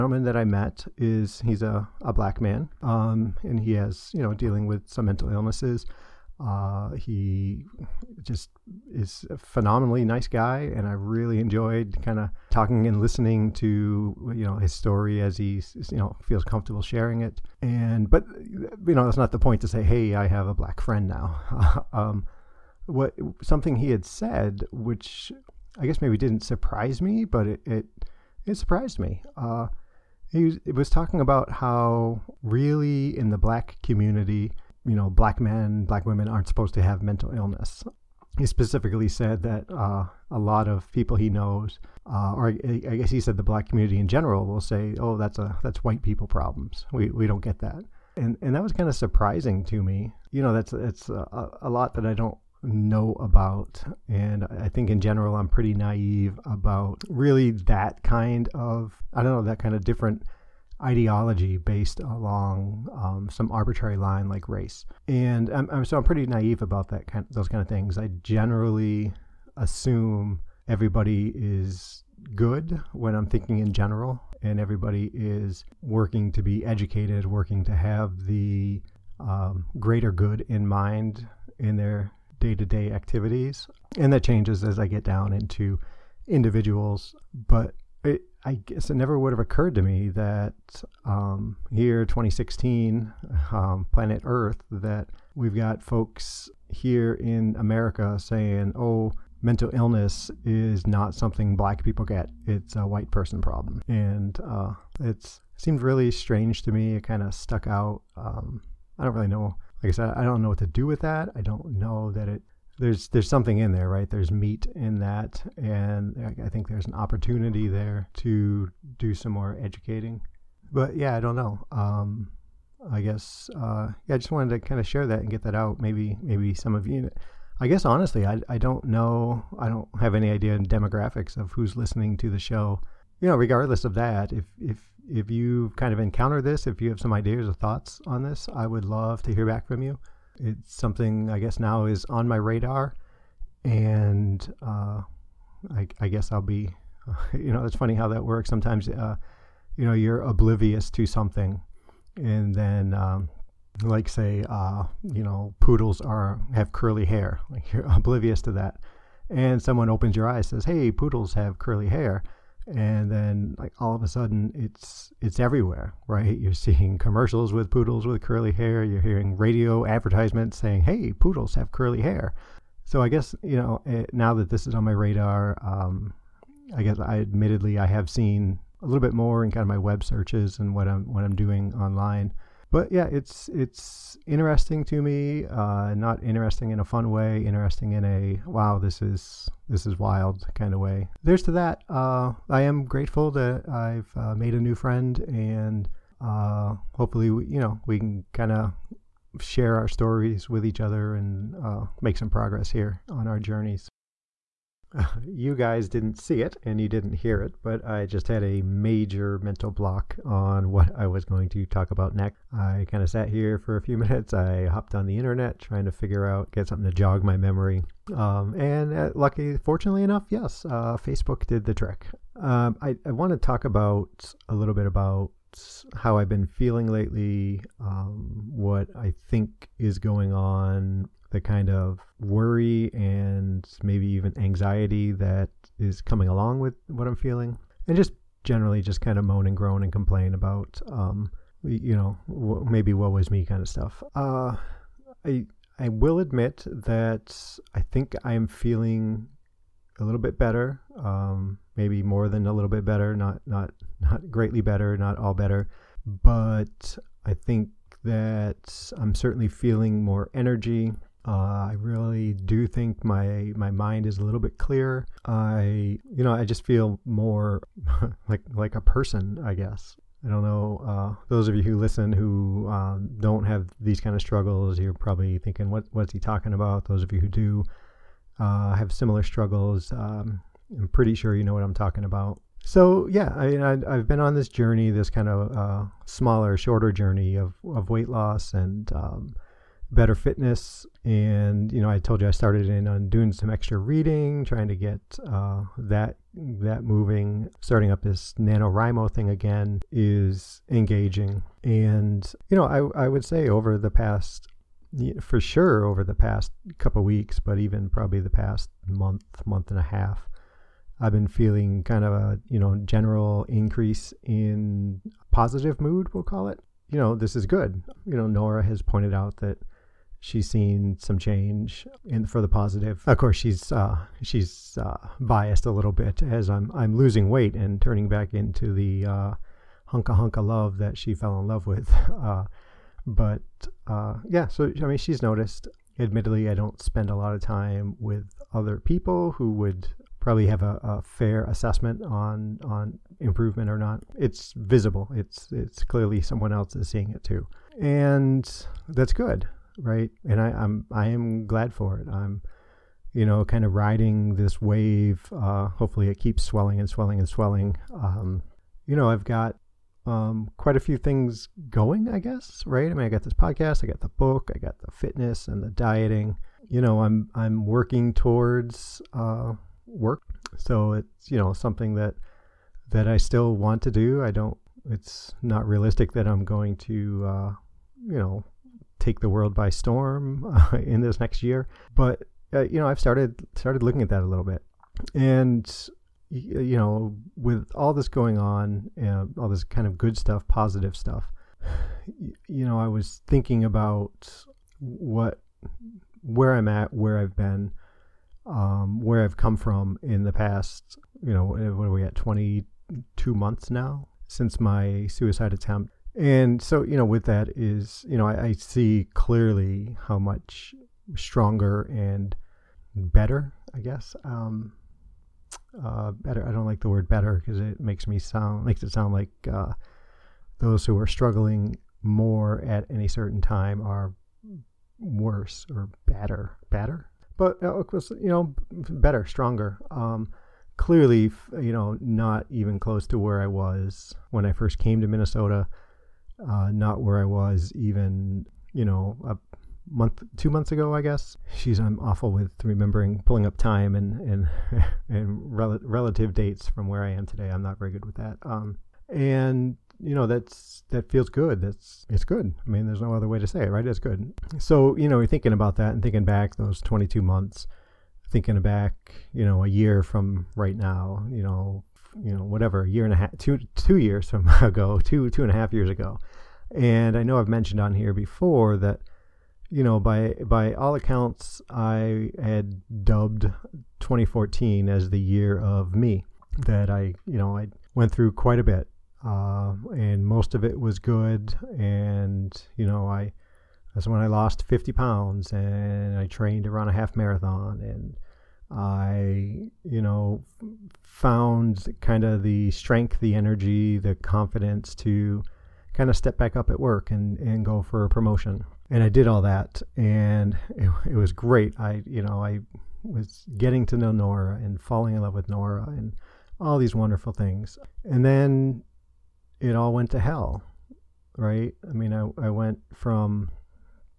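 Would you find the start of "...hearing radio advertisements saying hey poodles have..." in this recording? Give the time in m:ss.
2:49.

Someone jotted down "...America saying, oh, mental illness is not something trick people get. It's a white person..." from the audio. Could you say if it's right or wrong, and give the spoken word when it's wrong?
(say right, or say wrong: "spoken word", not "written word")
wrong: "black", not "trick".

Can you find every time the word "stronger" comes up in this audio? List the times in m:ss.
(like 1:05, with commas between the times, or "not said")
6:51, 7:09.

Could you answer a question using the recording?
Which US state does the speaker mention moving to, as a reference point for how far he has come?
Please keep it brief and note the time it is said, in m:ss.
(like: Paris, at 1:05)
Minnesota, at 7:15.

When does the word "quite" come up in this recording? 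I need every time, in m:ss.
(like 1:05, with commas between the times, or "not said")
6:00, 7:58.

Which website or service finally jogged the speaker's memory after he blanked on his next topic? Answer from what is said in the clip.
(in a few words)
Facebook.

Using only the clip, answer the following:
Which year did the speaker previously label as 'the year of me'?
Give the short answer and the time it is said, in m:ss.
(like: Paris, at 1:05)
2014, at 7:54.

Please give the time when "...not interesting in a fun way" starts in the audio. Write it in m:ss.
3:05.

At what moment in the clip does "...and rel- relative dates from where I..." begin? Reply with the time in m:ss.
7:25.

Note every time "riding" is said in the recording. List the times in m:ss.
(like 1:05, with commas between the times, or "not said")
5:53.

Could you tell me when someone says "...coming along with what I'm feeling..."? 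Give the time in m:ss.
3:56.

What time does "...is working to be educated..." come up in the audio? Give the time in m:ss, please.
1:15.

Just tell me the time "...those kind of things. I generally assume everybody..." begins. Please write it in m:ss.
1:07.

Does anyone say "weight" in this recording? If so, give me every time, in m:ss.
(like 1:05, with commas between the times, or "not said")
4:47, 5:27.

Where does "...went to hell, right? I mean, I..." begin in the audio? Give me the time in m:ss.
8:29.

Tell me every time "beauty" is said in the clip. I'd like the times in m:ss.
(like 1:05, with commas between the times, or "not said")
not said.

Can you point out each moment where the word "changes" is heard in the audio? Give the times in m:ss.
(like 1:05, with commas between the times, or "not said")
1:24, 5:21.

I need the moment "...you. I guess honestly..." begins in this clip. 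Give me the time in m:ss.
2:06.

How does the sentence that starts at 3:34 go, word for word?
I hopped on the internet trying to figure out, get something to jog my memory.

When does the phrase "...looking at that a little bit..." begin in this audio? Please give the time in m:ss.
6:23.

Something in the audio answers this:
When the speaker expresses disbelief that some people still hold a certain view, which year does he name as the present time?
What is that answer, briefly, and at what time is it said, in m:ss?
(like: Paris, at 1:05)
2016, at 1:32.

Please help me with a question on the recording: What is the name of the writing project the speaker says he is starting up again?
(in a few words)
NaNoWriMo.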